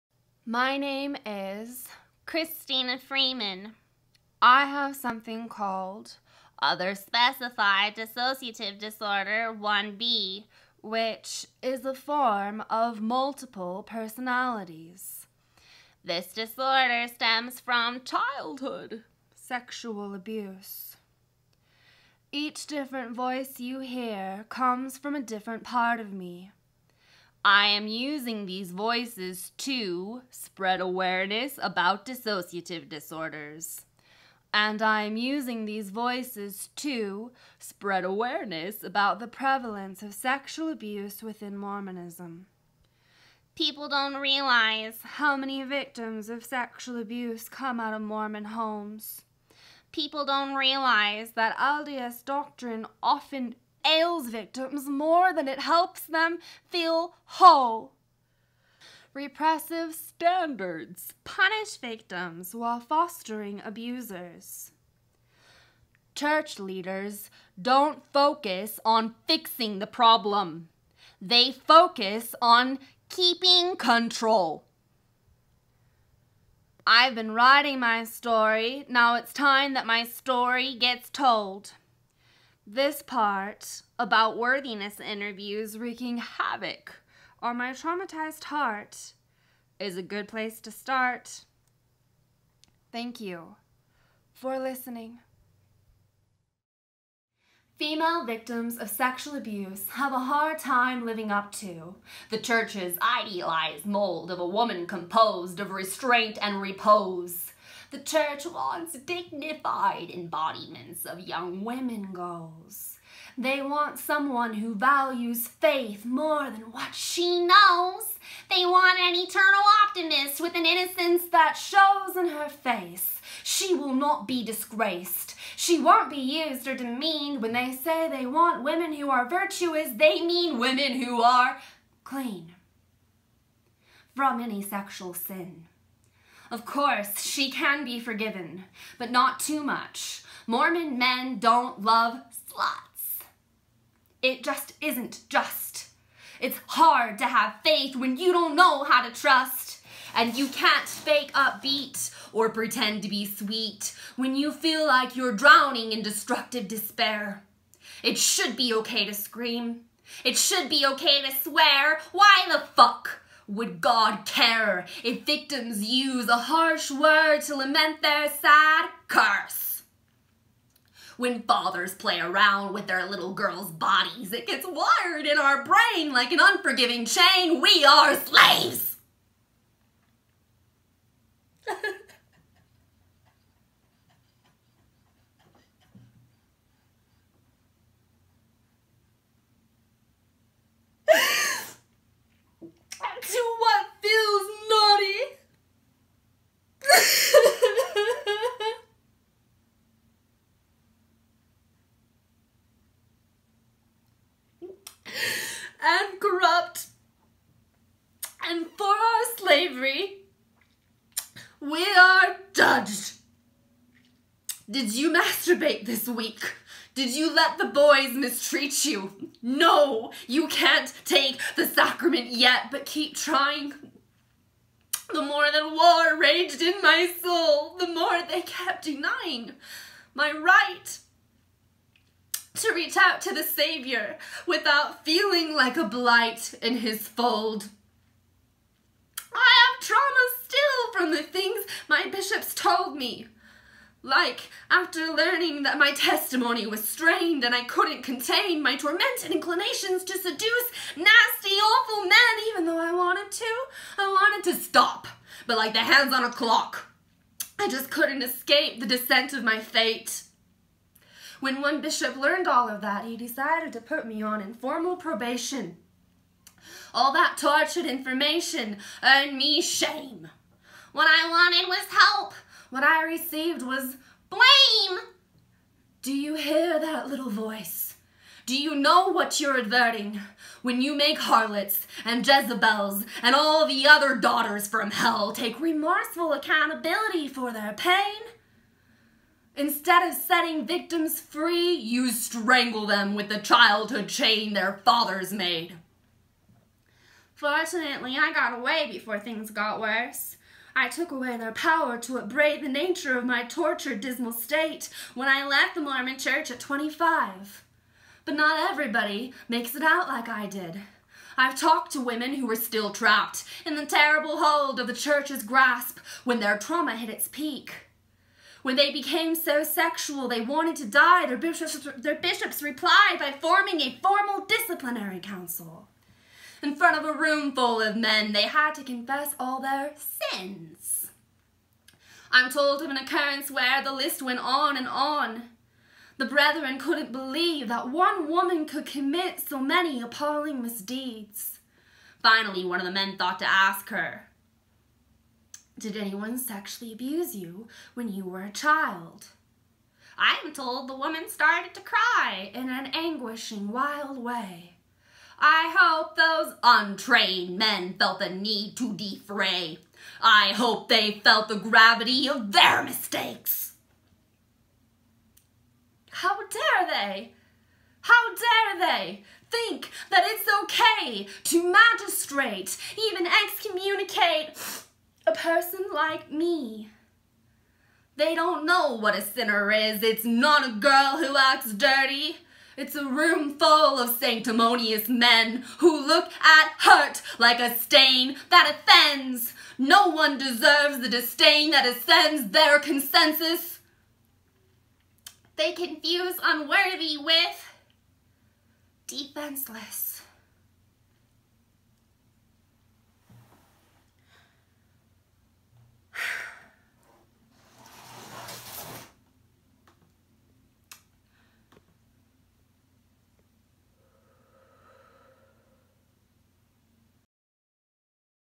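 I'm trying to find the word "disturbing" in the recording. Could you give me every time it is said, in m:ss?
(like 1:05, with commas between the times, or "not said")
not said.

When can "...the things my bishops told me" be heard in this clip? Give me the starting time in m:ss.
4:01.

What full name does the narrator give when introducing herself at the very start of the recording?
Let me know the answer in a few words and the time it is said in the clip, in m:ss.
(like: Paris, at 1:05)
Christina Freeman, at 0:02.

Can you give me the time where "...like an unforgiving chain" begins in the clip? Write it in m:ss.
2:56.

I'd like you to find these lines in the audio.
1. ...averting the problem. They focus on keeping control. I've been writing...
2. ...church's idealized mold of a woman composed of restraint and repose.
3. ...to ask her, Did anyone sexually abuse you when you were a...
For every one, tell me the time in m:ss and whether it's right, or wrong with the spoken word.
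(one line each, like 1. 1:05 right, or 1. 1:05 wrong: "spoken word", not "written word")
1. 1:09 wrong: "fixing", not "averting"
2. 1:42 right
3. 5:43 right.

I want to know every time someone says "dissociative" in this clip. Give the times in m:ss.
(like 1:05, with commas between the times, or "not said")
0:07, 0:32.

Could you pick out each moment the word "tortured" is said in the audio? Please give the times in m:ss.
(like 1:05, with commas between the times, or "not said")
4:27, 5:03.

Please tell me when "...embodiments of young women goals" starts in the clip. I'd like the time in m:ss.
1:50.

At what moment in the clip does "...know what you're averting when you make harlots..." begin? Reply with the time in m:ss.
4:38.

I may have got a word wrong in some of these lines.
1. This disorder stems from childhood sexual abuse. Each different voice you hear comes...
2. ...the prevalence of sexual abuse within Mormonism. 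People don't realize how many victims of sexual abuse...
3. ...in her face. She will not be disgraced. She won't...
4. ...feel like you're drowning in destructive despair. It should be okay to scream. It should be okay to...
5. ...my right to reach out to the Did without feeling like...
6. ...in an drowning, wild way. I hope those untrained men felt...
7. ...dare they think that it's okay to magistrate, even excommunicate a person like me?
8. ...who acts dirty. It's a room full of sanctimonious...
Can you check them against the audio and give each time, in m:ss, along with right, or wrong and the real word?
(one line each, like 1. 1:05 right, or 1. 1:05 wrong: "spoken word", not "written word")
1. 0:16 right
2. 0:39 right
3. 2:02 right
4. 2:34 right
5. 3:50 wrong: "Savior", not "Did"
6. 5:52 wrong: "anguishing", not "drowning"
7. 6:08 right
8. 6:21 right.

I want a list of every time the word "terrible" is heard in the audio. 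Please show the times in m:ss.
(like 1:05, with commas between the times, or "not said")
5:13.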